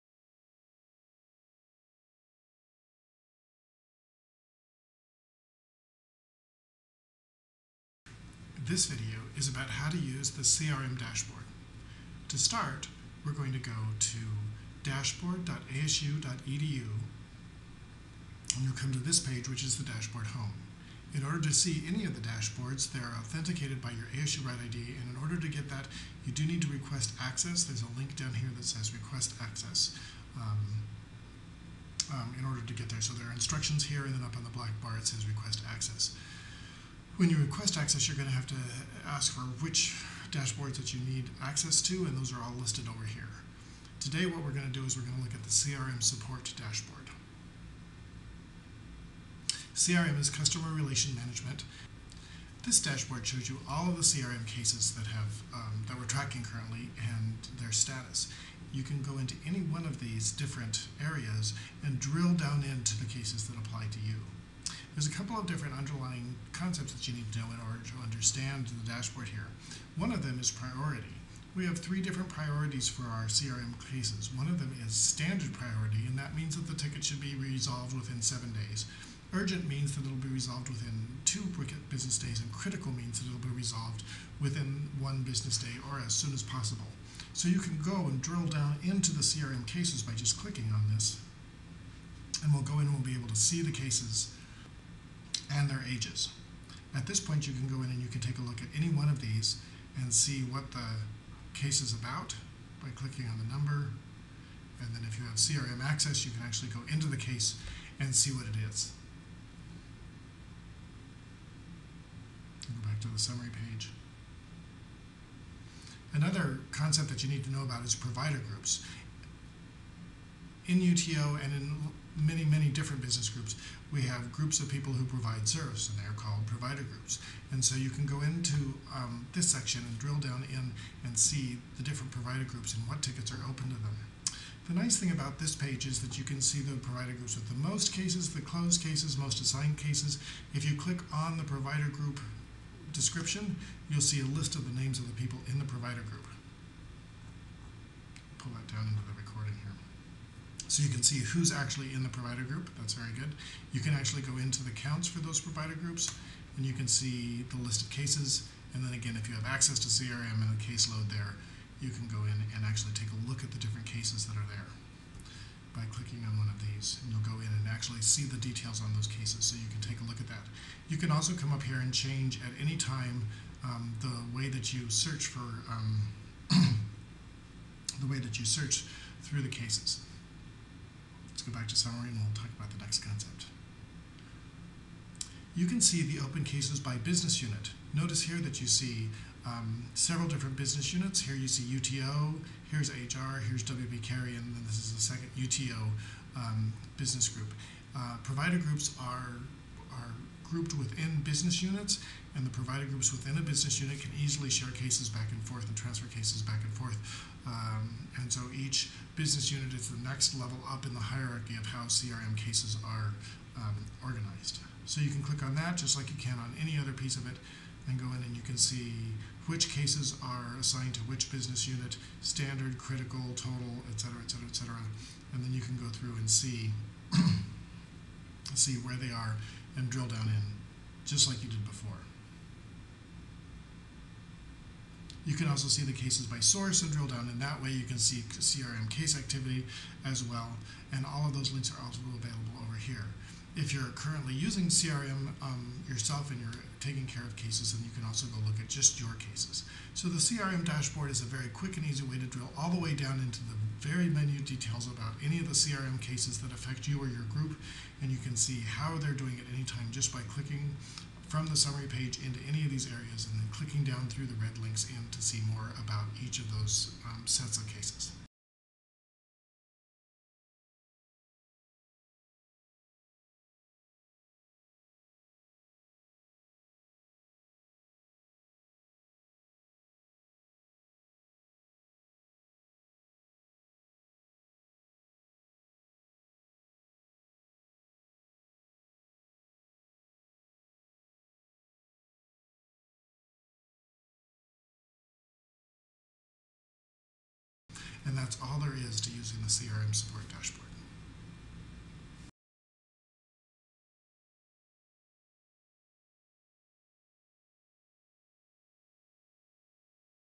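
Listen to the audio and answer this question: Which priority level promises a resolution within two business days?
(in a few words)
Urgent.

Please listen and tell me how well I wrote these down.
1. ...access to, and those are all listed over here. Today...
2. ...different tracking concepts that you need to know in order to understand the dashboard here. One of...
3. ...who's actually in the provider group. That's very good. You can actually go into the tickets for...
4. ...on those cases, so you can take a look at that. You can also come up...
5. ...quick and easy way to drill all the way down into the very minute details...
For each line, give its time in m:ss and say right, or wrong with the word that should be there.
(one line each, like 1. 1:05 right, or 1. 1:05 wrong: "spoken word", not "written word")
1. 0:41 right
2. 1:05 wrong: "underlying", not "tracking"
3. 2:31 wrong: "counts", not "tickets"
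4. 2:48 right
5. 4:11 right.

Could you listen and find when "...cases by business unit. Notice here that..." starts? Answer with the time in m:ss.
3:06.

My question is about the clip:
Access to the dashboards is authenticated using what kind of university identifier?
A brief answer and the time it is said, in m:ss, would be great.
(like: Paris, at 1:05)
ASURITE ID, at 0:24.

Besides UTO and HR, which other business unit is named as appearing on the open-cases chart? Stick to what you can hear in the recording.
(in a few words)
WP Carey.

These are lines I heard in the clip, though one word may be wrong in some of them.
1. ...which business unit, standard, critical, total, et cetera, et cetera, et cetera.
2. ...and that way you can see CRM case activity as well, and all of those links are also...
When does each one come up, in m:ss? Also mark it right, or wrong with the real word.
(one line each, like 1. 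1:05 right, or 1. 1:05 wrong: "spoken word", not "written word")
1. 3:41 right
2. 3:57 right.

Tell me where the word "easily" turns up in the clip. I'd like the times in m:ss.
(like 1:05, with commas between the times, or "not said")
3:24.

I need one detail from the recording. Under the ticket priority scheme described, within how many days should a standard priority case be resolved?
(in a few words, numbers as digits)
7 days.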